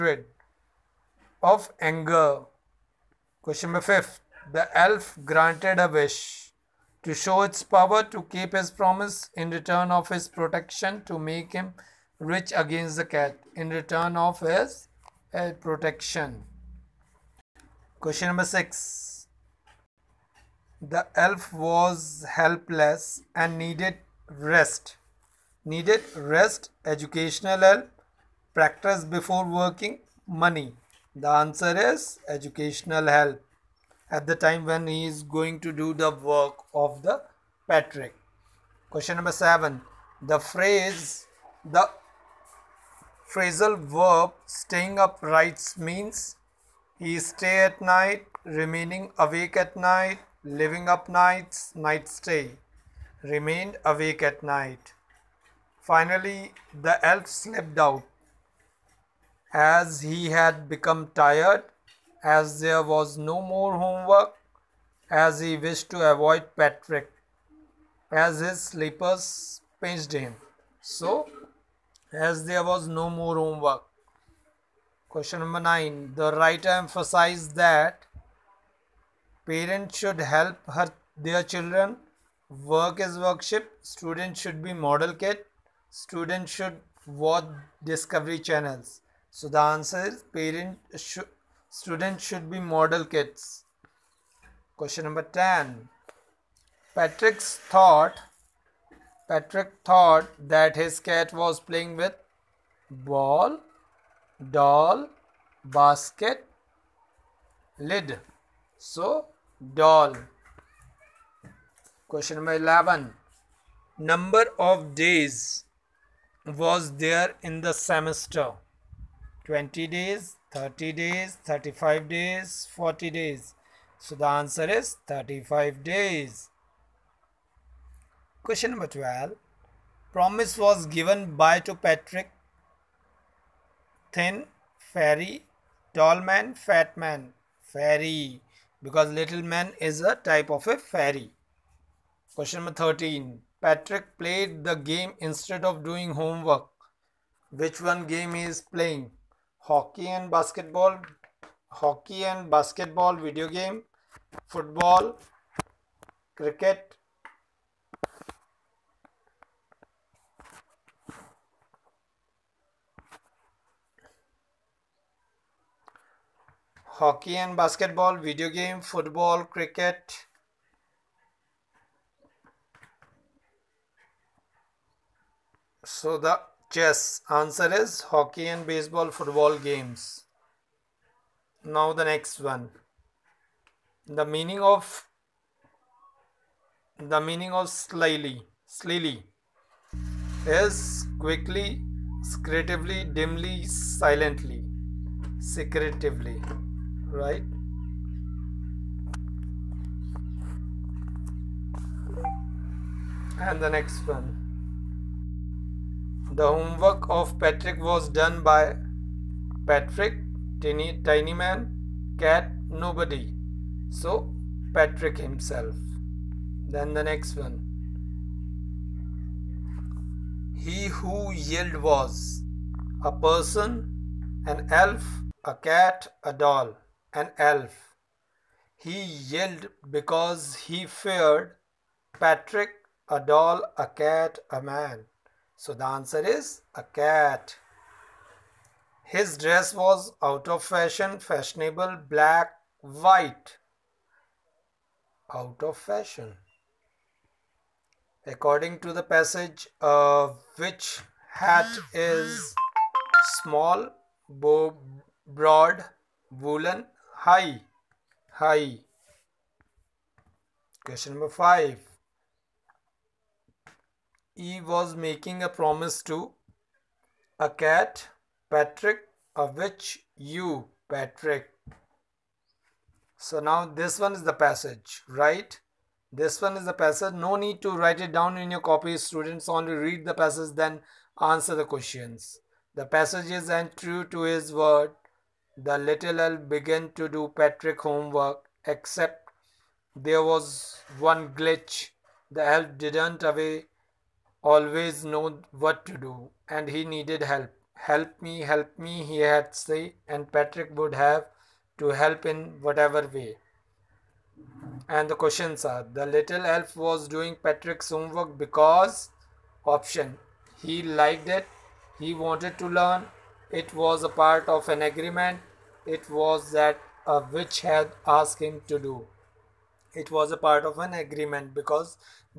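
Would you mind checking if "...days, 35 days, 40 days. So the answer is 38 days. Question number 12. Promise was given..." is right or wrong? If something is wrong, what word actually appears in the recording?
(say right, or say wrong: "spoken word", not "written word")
wrong: "35", not "38".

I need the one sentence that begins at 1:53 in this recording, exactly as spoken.
Number of days was there in the semester?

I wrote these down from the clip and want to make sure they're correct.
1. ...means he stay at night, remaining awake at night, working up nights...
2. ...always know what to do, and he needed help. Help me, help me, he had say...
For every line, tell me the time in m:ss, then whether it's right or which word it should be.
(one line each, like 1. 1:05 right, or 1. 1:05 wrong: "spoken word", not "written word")
1. 0:45 wrong: "living", not "working"
2. 4:54 right.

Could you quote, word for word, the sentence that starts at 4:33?
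So now this one is the passage, right?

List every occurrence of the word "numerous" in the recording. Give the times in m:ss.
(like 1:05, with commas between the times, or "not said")
not said.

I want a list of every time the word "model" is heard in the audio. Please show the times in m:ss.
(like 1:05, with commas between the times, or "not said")
1:24, 1:32.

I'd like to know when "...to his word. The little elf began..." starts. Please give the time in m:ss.
4:44.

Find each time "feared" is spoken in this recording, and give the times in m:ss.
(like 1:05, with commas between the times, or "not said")
3:50.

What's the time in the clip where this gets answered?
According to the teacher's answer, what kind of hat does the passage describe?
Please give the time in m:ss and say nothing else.
4:17.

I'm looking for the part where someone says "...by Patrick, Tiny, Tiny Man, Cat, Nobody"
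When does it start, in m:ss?
3:28.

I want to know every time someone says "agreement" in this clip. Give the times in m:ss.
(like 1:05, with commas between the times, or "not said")
5:14, 5:20.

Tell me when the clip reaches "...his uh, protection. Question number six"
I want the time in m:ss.
0:14.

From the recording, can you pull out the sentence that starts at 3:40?
He who yelled was a person, an elf, a cat, a doll, an elf.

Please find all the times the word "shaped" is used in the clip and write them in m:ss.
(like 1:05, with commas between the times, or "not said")
not said.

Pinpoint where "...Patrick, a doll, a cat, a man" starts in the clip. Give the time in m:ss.
3:52.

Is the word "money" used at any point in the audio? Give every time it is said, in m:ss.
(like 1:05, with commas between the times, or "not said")
0:30.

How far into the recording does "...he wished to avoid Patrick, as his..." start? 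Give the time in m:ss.
1:05.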